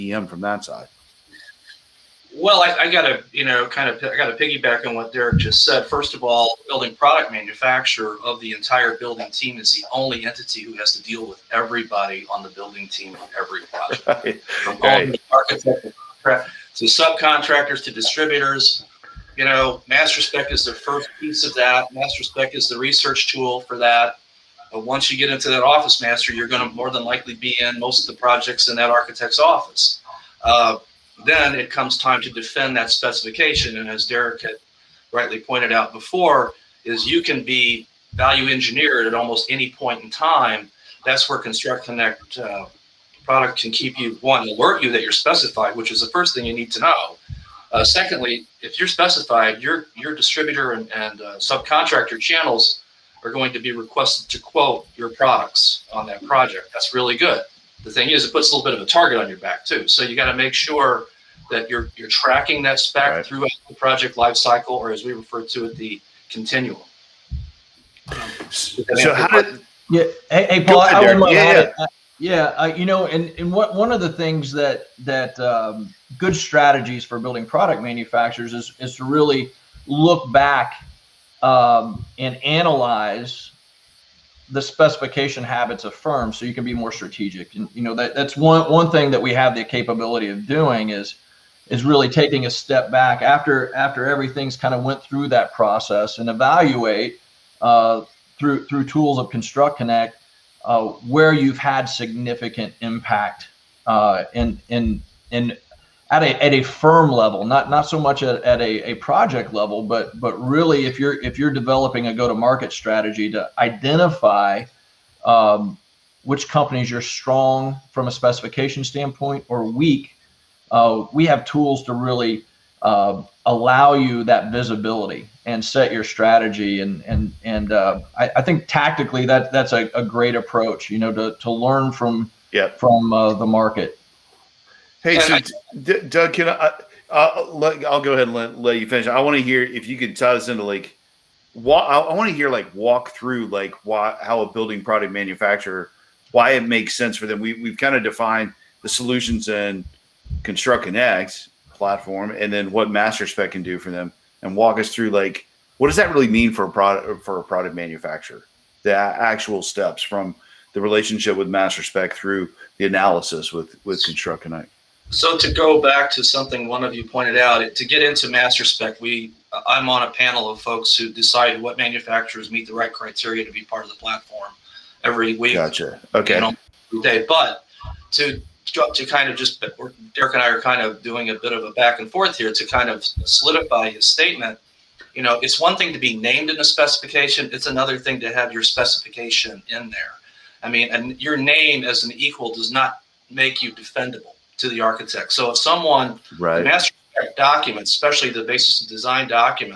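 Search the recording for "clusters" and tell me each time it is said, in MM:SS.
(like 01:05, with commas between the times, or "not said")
not said.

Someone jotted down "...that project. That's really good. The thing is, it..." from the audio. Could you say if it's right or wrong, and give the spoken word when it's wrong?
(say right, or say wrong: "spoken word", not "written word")
right.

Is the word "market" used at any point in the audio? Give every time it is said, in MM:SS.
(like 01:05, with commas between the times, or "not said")
01:52, 02:13.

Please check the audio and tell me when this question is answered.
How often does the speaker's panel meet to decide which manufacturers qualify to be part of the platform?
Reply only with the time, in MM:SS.
02:55.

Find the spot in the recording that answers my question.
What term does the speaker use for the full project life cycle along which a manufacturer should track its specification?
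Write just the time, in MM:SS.
01:05.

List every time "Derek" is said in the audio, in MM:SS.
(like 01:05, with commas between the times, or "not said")
00:05, 00:34, 03:00.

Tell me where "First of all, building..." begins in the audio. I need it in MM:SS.
00:05.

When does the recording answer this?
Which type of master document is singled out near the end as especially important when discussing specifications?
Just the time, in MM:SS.
03:18.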